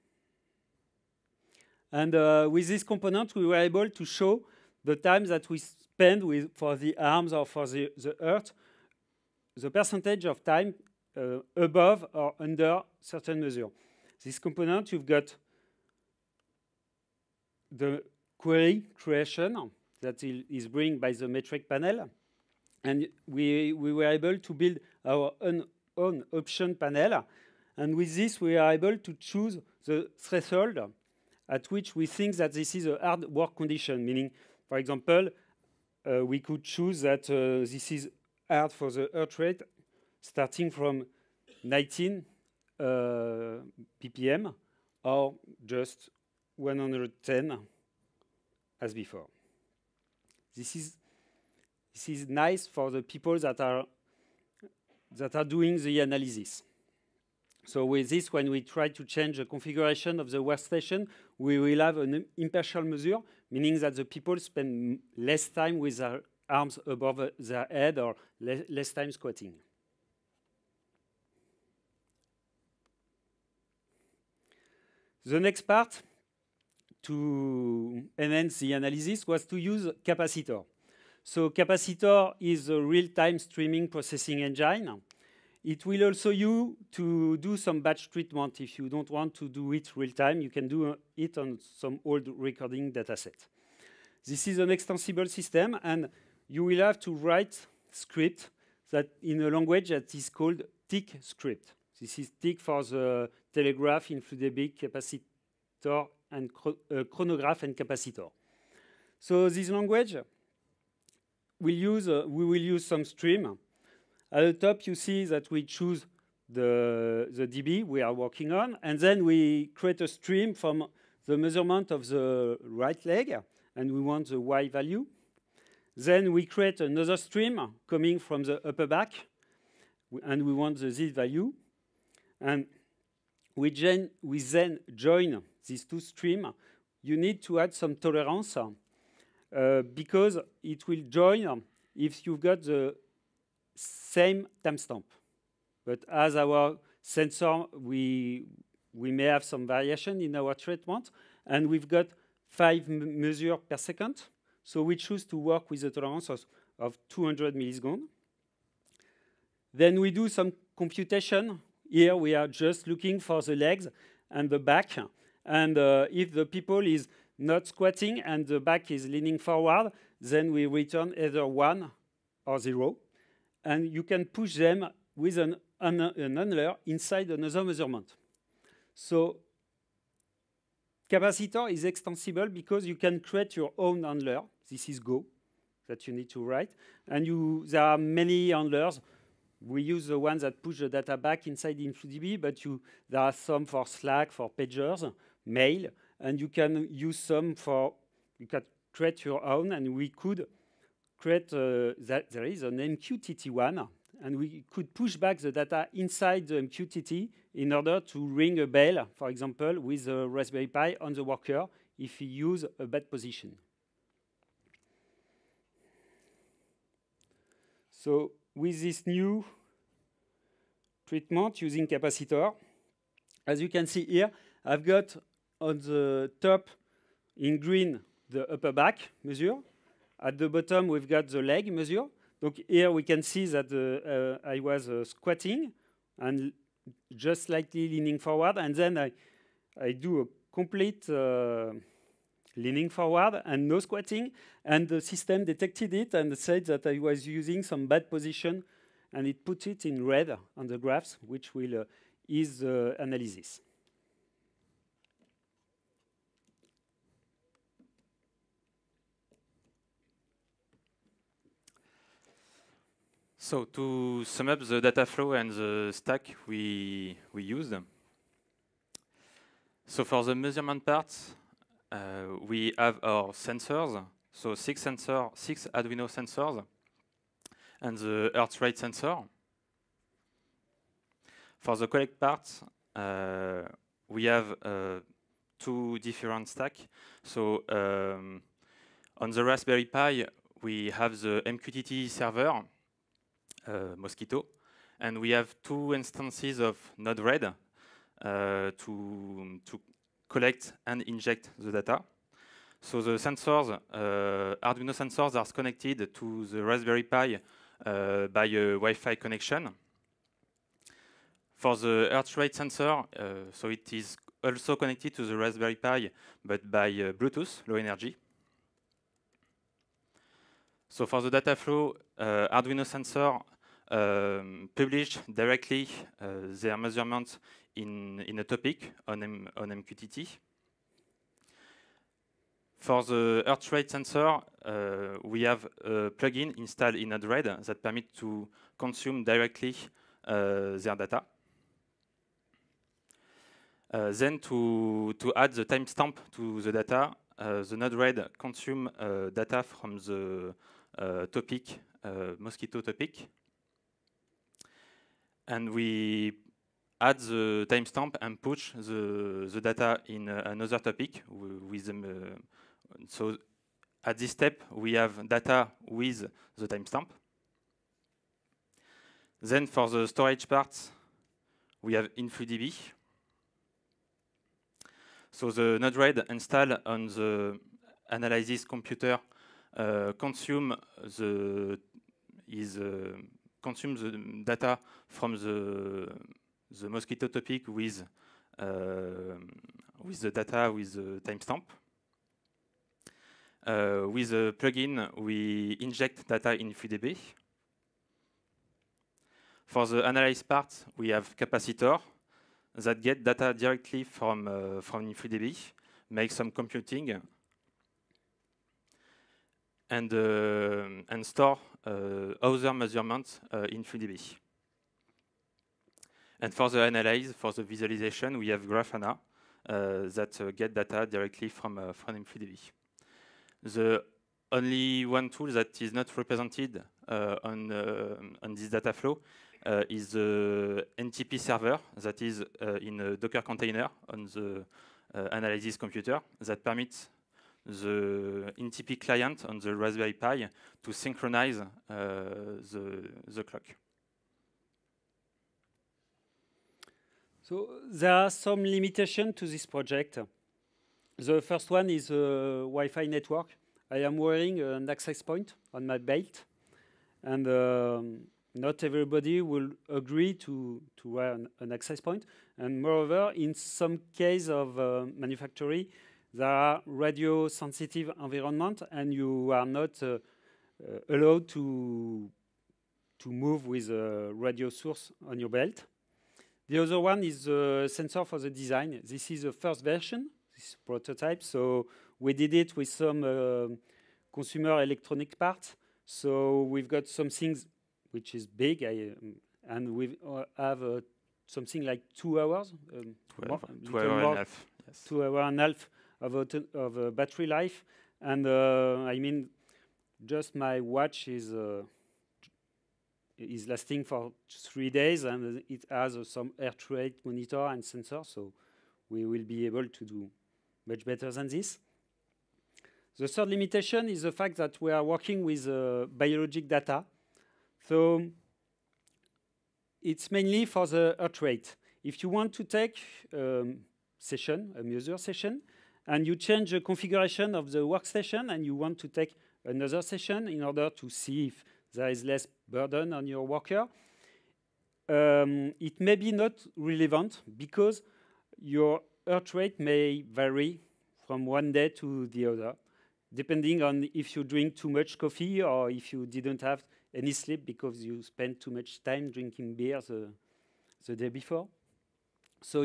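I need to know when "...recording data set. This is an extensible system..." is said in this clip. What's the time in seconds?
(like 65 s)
92 s.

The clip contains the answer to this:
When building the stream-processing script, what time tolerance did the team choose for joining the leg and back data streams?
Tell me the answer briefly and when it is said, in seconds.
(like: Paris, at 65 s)
200 milliseconds, at 157 s.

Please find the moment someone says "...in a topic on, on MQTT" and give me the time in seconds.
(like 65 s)
328 s.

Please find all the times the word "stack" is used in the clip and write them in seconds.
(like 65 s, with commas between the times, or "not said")
265 s, 286 s.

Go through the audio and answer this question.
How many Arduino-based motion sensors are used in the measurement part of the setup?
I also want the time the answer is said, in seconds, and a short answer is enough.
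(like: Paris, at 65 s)
6, at 275 s.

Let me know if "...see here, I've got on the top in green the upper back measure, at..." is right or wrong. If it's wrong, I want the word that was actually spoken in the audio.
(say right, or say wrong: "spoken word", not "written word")
right.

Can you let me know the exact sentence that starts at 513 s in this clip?
The third limitation is the fact that we are working with biologic data.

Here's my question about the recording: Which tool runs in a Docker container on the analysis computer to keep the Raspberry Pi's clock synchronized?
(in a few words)
NTP server.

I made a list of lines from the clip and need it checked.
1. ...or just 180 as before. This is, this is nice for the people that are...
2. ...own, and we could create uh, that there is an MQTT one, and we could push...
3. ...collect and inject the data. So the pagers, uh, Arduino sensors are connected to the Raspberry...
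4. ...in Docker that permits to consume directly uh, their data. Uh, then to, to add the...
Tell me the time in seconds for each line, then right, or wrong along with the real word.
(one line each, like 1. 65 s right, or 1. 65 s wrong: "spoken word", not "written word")
1. 45 s wrong: "110", not "180"
2. 199 s right
3. 300 s wrong: "sensors", not "pagers"
4. 336 s wrong: "Android", not "Docker".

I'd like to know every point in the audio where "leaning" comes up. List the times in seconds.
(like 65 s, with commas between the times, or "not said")
169 s, 237 s, 242 s.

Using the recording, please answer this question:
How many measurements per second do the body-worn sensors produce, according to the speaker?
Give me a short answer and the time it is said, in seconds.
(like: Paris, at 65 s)
5, at 152 s.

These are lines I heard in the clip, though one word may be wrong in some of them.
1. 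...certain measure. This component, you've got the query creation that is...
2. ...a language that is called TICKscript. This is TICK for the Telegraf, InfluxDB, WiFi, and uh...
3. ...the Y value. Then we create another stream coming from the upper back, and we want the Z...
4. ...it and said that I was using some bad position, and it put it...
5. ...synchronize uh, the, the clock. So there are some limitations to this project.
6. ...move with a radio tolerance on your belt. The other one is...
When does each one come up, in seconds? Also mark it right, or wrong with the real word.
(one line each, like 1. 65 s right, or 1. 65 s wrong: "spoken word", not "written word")
1. 13 s right
2. 99 s wrong: "Kapacitor", not "WiFi"
3. 124 s right
4. 245 s right
5. 440 s right
6. 473 s wrong: "source", not "tolerance".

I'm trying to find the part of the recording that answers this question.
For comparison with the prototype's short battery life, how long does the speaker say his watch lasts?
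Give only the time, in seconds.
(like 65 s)
504 s.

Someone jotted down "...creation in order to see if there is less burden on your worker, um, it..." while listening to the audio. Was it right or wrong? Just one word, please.
wrong.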